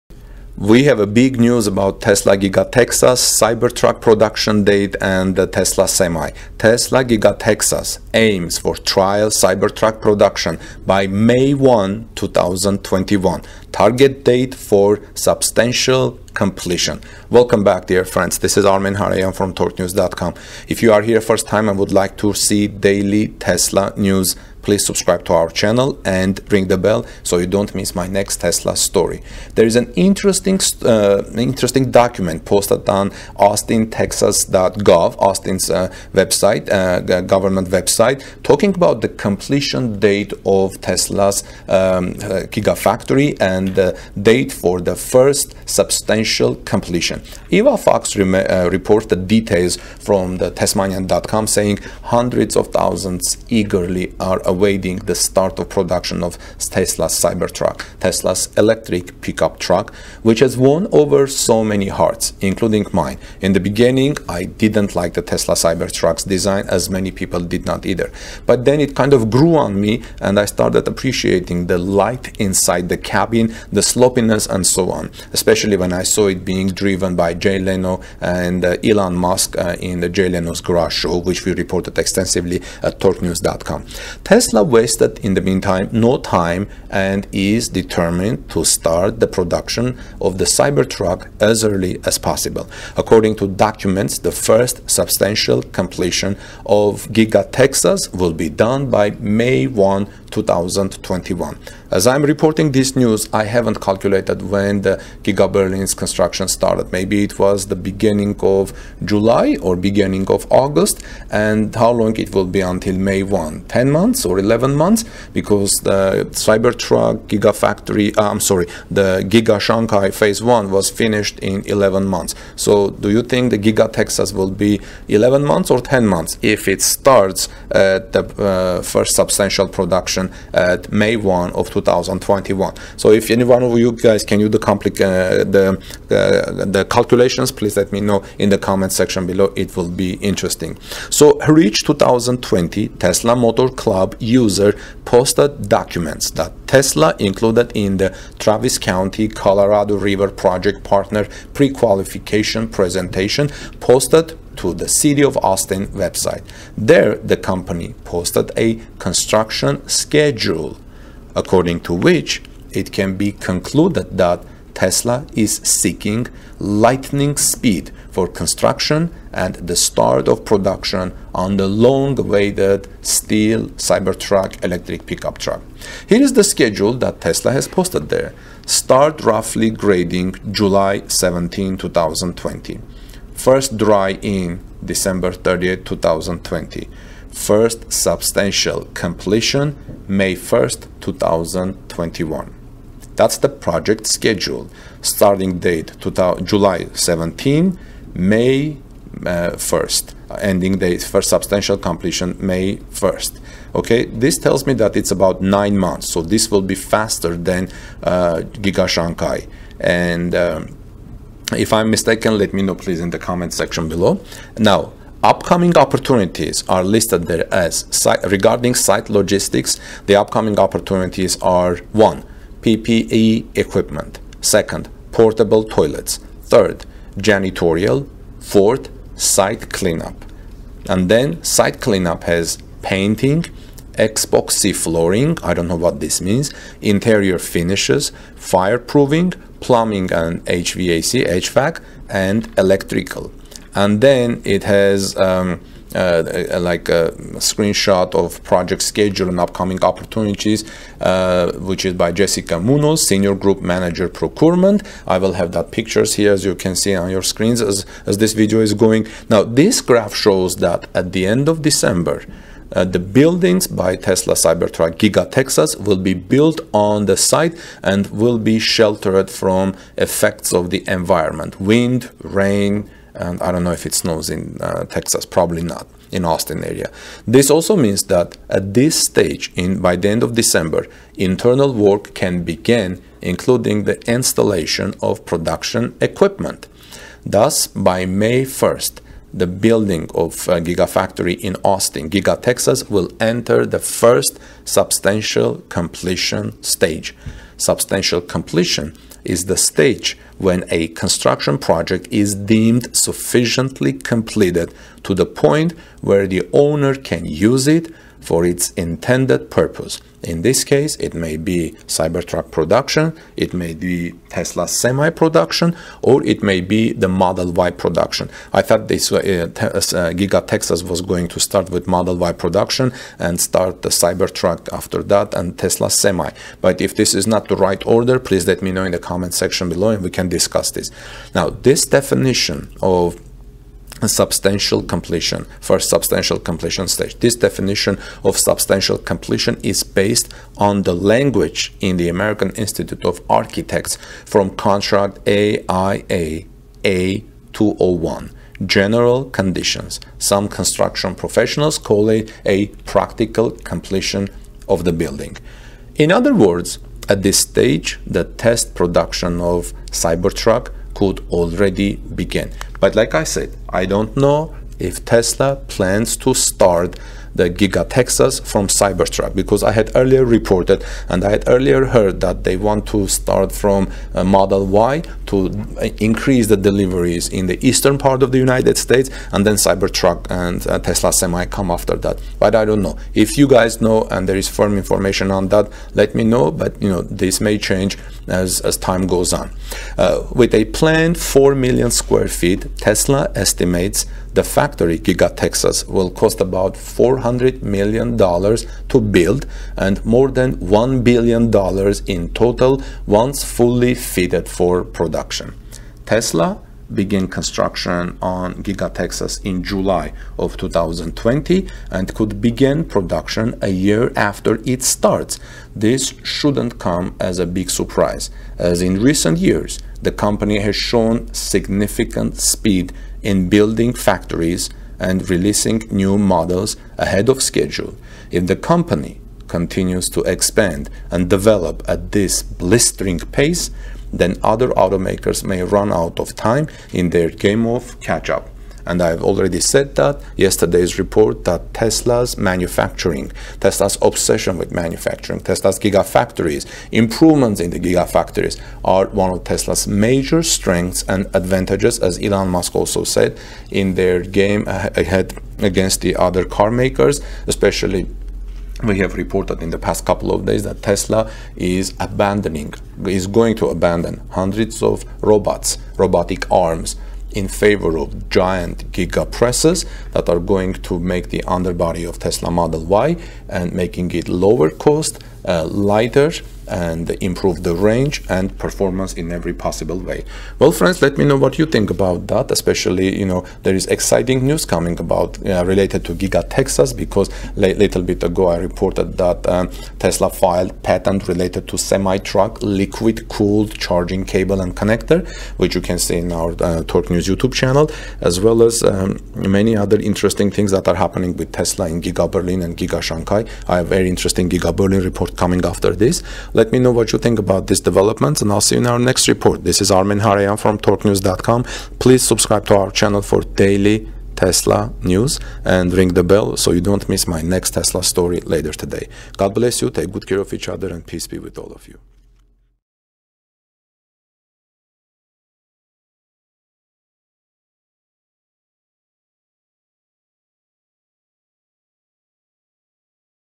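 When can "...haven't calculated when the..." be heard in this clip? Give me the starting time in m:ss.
1:43.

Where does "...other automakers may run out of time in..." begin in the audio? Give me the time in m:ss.
7:14.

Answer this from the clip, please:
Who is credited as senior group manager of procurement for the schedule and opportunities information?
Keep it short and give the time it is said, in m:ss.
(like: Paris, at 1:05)
Jessica Munoz, at 4:12.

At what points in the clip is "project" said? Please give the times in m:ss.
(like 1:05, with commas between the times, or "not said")
2:30, 3:13, 4:08, 5:01.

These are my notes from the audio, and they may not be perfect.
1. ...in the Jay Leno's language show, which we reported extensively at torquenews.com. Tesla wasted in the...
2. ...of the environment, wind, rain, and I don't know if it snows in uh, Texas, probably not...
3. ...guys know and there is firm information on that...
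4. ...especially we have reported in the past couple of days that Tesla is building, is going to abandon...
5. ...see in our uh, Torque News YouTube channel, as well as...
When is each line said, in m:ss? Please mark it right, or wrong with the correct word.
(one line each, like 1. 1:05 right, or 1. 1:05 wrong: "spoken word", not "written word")
1. 1:19 wrong: "garage", not "language"
2. 4:30 right
3. 6:23 right
4. 7:37 wrong: "abandoning", not "building"
5. 8:15 right.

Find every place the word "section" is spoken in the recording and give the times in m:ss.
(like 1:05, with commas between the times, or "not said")
2:18, 3:33, 5:29.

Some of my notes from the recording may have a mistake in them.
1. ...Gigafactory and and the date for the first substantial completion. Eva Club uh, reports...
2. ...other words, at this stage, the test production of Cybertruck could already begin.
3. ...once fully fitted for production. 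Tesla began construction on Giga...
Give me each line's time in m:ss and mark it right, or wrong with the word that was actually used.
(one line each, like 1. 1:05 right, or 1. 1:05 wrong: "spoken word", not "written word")
1. 0:42 wrong: "Fox", not "Club"
2. 5:56 right
3. 6:43 right.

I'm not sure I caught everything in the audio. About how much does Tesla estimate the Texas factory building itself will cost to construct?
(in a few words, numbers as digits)
$400 million.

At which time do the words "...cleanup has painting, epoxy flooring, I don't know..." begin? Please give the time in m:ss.
3:51.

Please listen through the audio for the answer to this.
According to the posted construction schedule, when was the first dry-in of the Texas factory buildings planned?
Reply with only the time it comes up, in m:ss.
3:04.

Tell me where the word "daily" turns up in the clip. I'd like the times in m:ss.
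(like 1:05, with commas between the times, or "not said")
0:22, 8:33.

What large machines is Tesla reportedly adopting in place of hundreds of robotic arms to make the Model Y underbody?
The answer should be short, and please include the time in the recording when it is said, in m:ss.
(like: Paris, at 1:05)
Gigapresses, at 7:48.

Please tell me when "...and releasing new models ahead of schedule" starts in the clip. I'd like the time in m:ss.
7:04.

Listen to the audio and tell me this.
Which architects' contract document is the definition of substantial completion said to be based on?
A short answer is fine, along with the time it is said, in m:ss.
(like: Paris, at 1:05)
AIA A201, at 5:45.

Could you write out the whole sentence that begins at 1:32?
According to documents, the first substantial completion of Giga Texas will be done by May 1, 2021.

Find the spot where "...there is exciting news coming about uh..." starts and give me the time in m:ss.
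8:03.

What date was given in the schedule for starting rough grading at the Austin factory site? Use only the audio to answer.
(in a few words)
July 17, 2020.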